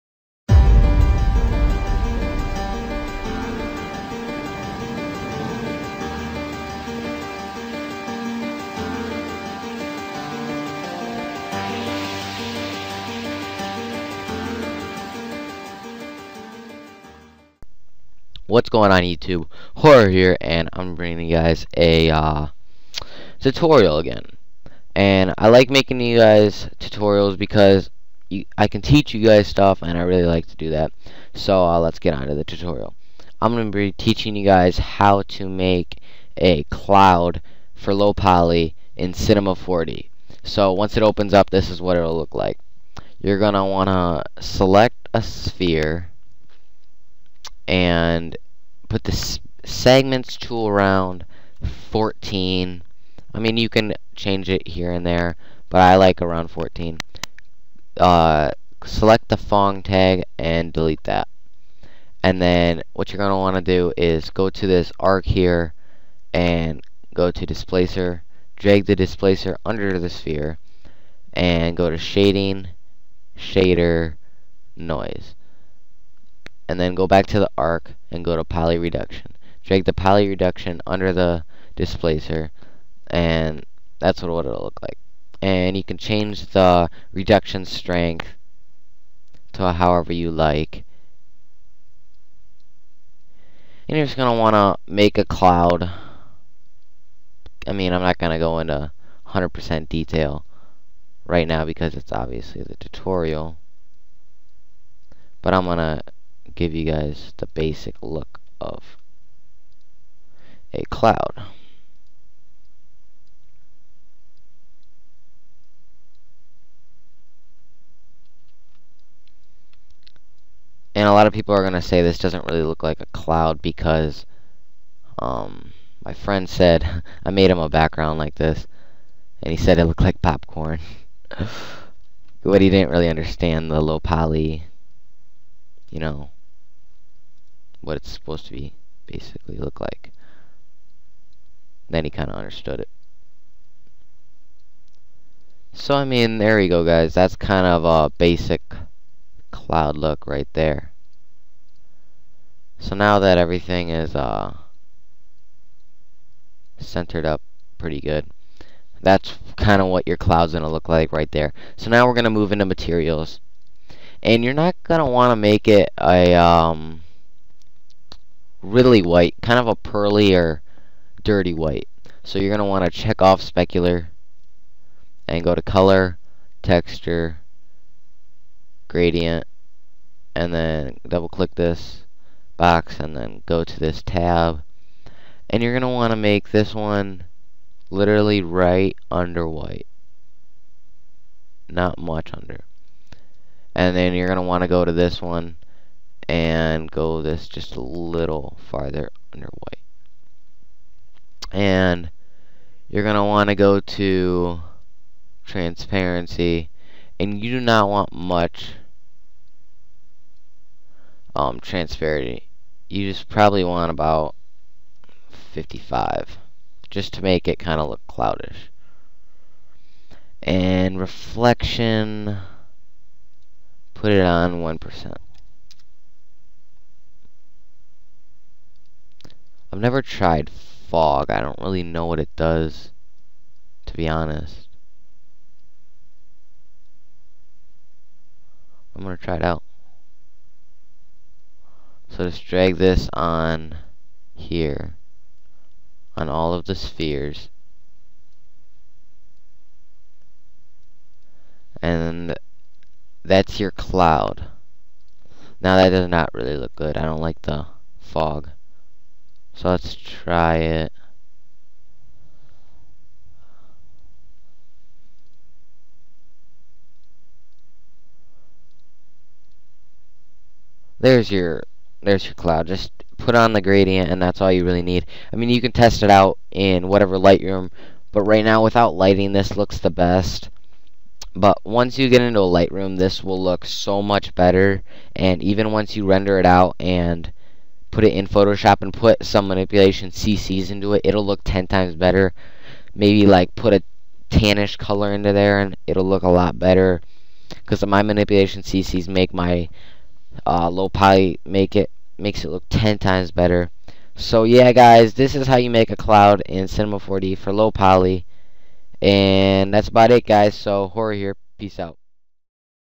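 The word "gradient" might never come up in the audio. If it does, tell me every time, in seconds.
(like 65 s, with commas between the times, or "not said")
178 s, 273 s.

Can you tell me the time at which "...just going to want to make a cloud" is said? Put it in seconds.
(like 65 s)
94 s.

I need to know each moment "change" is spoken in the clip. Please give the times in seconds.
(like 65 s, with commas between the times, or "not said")
54 s, 85 s.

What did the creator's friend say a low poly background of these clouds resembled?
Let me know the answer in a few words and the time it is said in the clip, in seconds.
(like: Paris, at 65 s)
popcorn, at 130 s.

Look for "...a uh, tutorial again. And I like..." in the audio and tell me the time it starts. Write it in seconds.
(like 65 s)
21 s.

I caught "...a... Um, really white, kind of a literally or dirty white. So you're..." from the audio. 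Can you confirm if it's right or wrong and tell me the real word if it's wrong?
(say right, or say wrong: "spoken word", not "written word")
wrong: "pearly", not "literally".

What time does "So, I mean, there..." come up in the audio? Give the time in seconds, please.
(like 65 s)
145 s.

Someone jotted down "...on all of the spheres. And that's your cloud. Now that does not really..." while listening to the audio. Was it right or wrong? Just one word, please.
right.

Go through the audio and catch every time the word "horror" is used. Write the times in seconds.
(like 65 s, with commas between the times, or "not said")
19 s, 310 s.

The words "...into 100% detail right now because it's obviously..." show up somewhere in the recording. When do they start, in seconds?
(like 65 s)
98 s.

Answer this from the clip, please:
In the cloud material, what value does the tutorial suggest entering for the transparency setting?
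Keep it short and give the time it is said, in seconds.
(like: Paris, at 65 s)
55, at 215 s.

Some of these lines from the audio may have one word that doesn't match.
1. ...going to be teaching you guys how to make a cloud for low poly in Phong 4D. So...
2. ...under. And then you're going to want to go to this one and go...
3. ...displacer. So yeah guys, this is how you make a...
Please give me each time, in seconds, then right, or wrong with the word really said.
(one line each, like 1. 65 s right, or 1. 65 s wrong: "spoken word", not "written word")
1. 33 s wrong: "Cinema", not "Phong"
2. 192 s right
3. 303 s wrong: "better", not "displacer".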